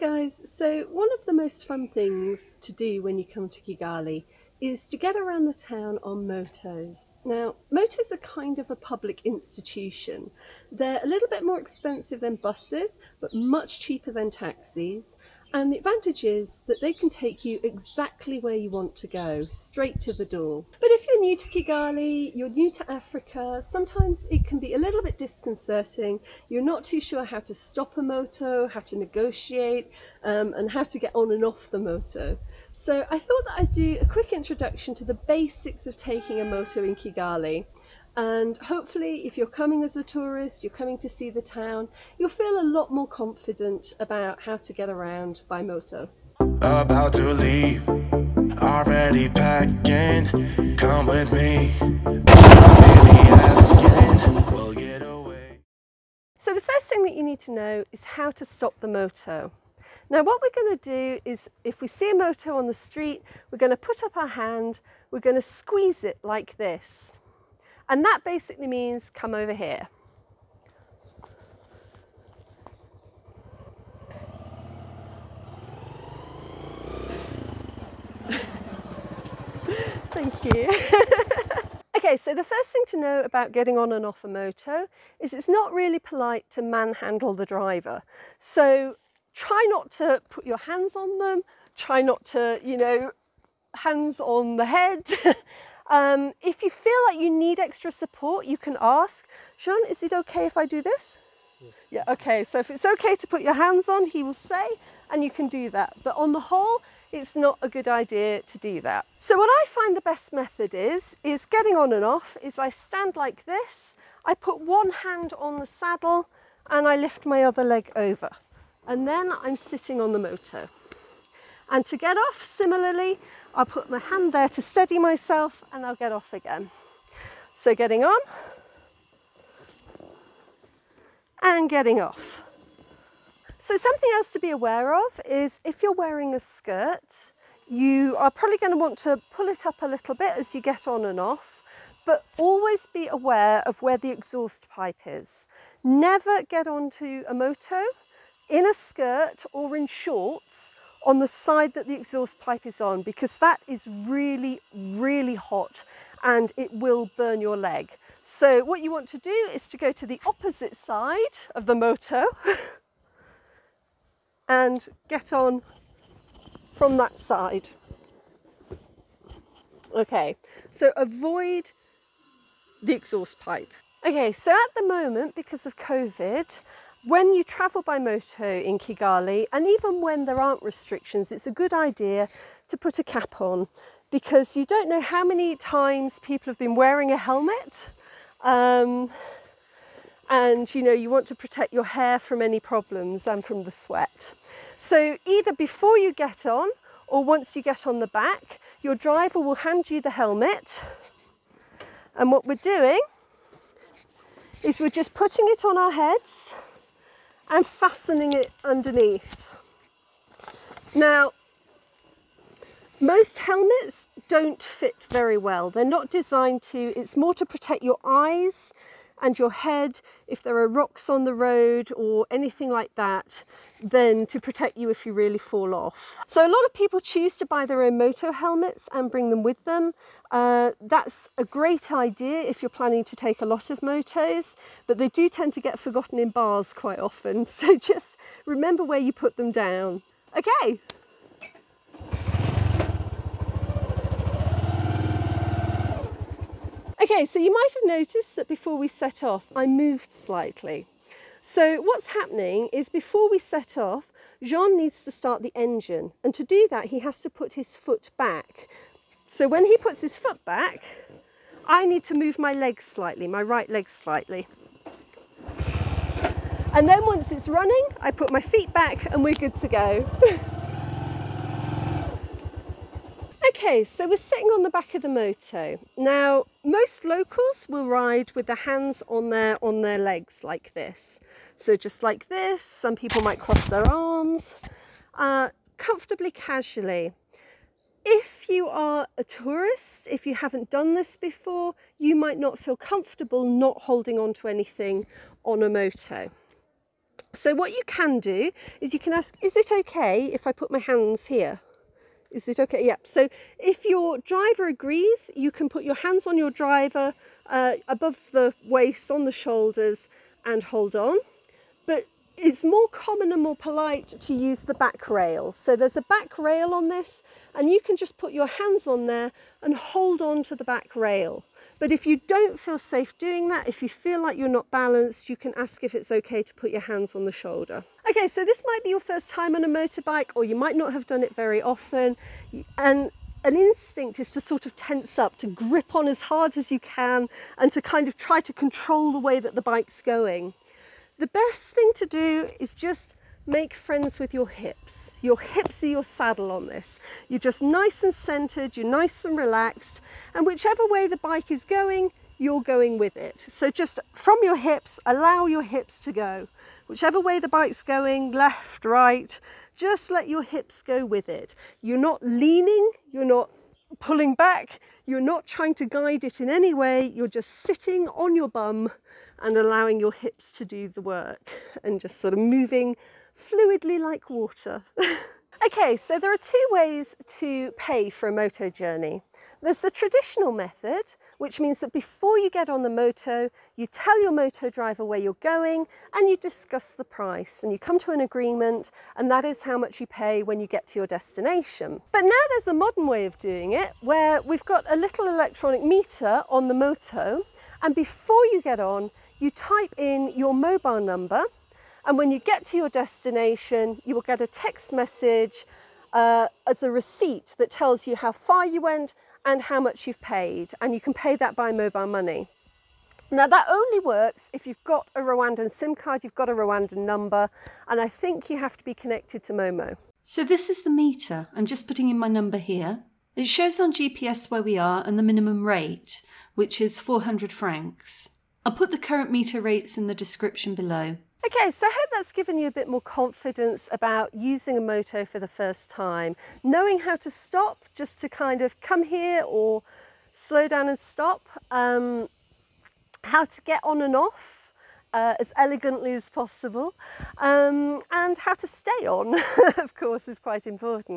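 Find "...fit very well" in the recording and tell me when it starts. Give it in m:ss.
3:34.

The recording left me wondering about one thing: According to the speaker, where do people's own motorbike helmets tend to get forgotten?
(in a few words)
bars.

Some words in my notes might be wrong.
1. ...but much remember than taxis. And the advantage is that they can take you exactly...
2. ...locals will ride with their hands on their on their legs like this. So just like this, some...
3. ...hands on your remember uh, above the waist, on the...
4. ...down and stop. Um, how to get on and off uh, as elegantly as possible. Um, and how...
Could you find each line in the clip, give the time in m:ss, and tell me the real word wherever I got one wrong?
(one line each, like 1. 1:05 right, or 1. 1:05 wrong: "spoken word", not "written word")
1. 0:13 wrong: "cheaper", not "remember"
2. 4:37 right
3. 5:05 wrong: "driver", not "remember"
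4. 7:20 right.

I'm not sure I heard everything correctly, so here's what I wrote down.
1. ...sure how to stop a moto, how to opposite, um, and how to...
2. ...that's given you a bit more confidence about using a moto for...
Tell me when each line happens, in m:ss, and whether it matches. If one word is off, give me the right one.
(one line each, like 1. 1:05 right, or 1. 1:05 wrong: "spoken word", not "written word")
1. 0:27 wrong: "negotiate", not "opposite"
2. 7:12 right.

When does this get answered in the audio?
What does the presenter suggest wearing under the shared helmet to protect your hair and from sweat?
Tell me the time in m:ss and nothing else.
3:02.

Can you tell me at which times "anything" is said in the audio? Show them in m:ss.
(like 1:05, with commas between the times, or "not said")
3:42, 4:54.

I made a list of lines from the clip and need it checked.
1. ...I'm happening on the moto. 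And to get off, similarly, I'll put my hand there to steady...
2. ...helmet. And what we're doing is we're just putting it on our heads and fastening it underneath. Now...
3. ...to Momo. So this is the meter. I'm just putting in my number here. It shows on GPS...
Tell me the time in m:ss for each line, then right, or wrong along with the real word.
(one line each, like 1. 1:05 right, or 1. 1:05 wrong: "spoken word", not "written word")
1. 1:59 wrong: "sitting", not "happening"
2. 3:20 right
3. 6:59 right.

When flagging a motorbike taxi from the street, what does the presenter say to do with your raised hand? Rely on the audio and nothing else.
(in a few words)
squeeze it.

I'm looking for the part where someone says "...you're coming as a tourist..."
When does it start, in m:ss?
0:39.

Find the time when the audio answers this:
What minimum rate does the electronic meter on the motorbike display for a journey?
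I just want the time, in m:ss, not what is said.
7:07.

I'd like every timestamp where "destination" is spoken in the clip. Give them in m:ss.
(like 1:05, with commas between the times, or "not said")
6:31, 6:42.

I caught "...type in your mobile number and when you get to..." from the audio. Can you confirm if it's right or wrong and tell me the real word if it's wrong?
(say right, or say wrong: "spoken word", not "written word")
right.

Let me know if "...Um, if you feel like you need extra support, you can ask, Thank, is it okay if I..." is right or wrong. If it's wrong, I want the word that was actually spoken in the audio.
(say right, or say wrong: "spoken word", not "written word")
wrong: "Sean", not "Thank".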